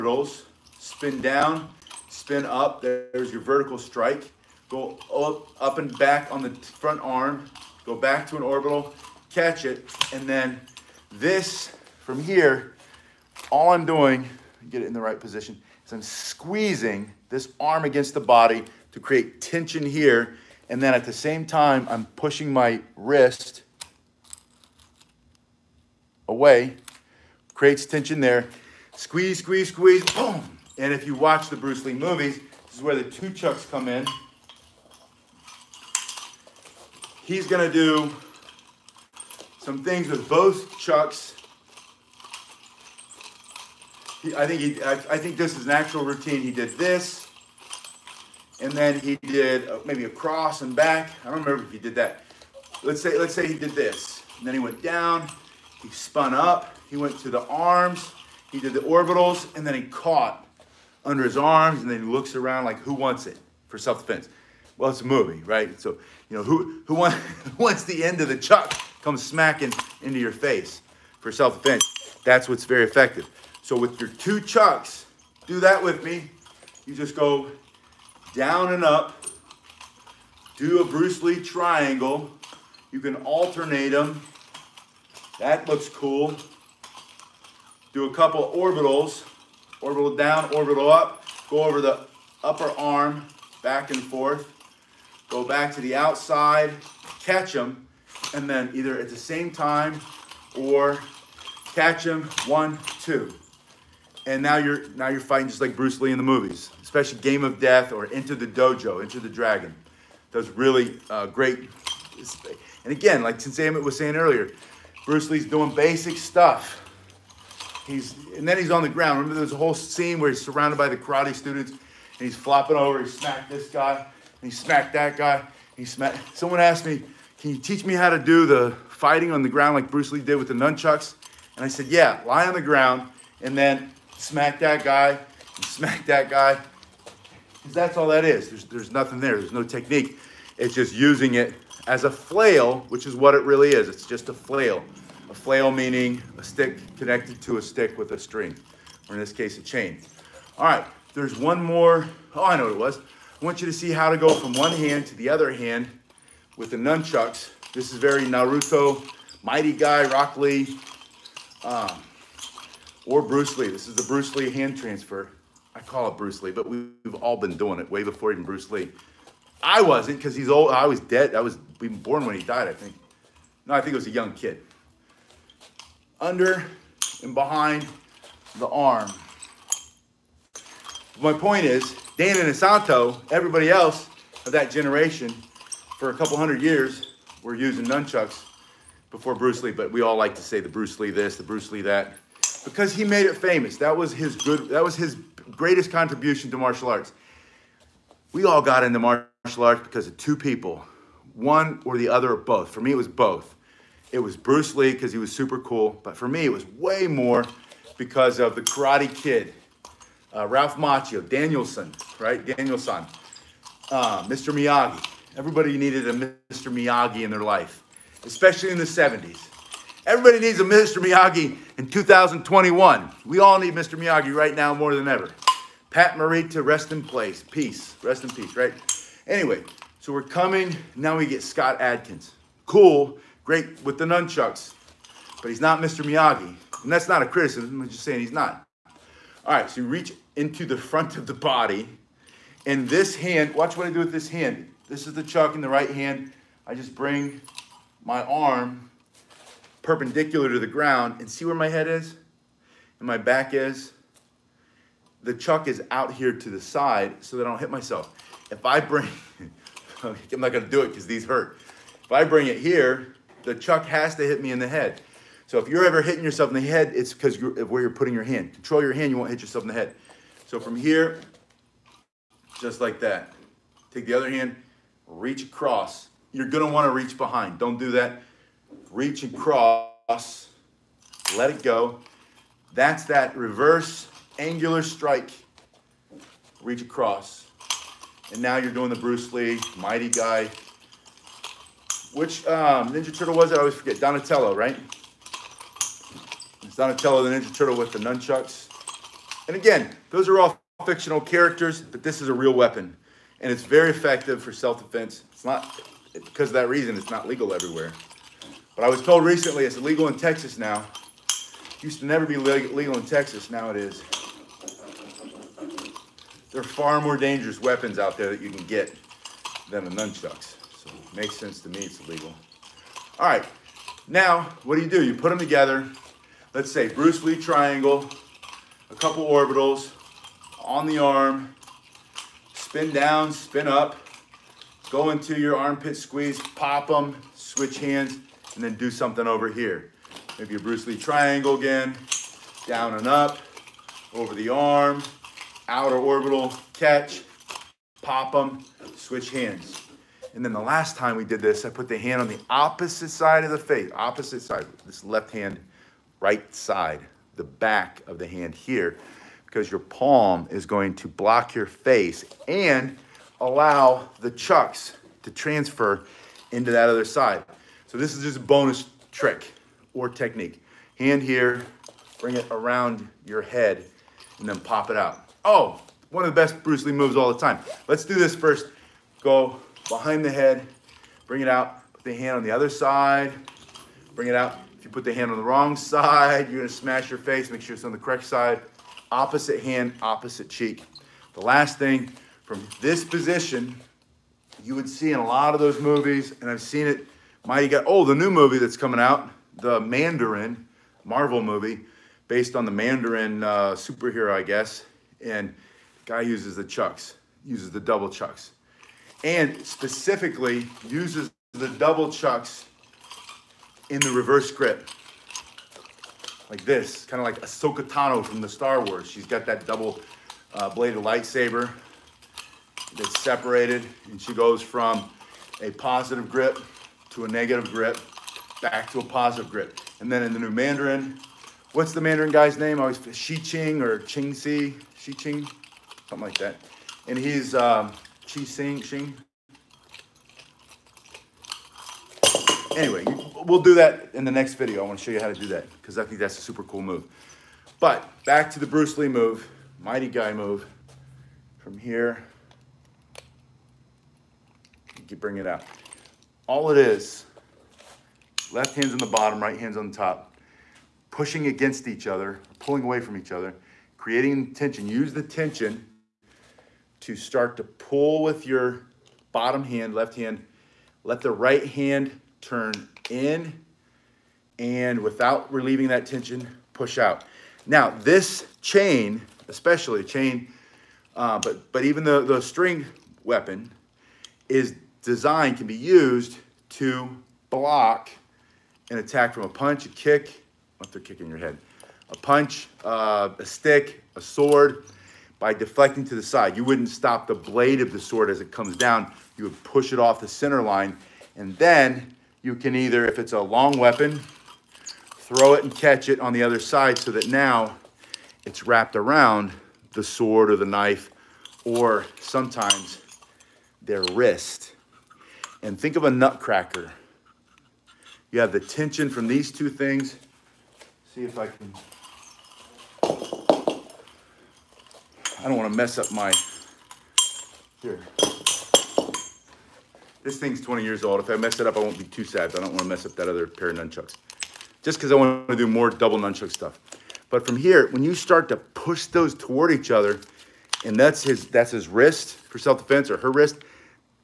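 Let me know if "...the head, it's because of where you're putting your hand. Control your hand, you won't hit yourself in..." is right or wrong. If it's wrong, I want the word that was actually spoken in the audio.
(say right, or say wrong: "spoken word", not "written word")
right.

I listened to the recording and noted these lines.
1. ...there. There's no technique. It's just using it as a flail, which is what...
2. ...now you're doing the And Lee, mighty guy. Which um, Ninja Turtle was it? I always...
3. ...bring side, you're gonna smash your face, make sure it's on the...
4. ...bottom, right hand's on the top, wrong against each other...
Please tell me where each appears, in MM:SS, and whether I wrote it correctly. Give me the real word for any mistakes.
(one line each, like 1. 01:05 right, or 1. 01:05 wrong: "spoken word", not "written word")
1. 02:19 right
2. 04:48 wrong: "Bruce", not "And"
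3. 06:25 wrong: "wrong", not "bring"
4. 07:39 wrong: "pushing", not "wrong".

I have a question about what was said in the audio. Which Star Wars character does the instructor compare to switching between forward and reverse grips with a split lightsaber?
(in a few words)
Ahsoka Tano.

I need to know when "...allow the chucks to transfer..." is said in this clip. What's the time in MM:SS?
06:03.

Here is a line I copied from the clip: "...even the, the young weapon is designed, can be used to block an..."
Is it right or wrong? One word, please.
wrong.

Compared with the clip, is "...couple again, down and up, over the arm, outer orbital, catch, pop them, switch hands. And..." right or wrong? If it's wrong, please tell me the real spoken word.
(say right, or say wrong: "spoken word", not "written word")
wrong: "triangle", not "couple".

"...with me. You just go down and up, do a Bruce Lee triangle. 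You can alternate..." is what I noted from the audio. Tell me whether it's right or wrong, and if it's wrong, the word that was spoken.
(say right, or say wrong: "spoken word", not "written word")
right.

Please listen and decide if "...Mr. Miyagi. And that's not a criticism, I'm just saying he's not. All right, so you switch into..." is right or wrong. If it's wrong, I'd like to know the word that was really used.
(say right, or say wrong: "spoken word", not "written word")
wrong: "reach", not "switch".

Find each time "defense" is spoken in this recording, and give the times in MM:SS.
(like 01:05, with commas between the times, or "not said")
01:03, 01:11, 05:04, 09:02.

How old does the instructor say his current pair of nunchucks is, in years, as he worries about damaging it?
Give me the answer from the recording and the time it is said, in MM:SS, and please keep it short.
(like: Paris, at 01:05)
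20, at 08:50.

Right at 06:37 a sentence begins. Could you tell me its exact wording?
Mighty got oh, the new movie that's coming out, the Mandarin Marvel movie, based on the Mandarin uh, superhero, I guess.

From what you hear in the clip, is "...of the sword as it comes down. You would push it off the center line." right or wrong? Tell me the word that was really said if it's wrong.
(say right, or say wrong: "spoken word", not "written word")
right.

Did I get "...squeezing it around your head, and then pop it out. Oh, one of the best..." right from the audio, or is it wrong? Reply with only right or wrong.
wrong.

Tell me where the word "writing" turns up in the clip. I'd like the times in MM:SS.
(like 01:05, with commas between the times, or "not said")
not said.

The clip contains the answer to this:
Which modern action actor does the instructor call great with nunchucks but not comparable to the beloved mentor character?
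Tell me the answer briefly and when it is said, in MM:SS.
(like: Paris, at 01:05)
Scott Adkins, at 03:51.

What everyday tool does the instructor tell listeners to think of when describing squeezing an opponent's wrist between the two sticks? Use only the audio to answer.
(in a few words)
A nutcracker.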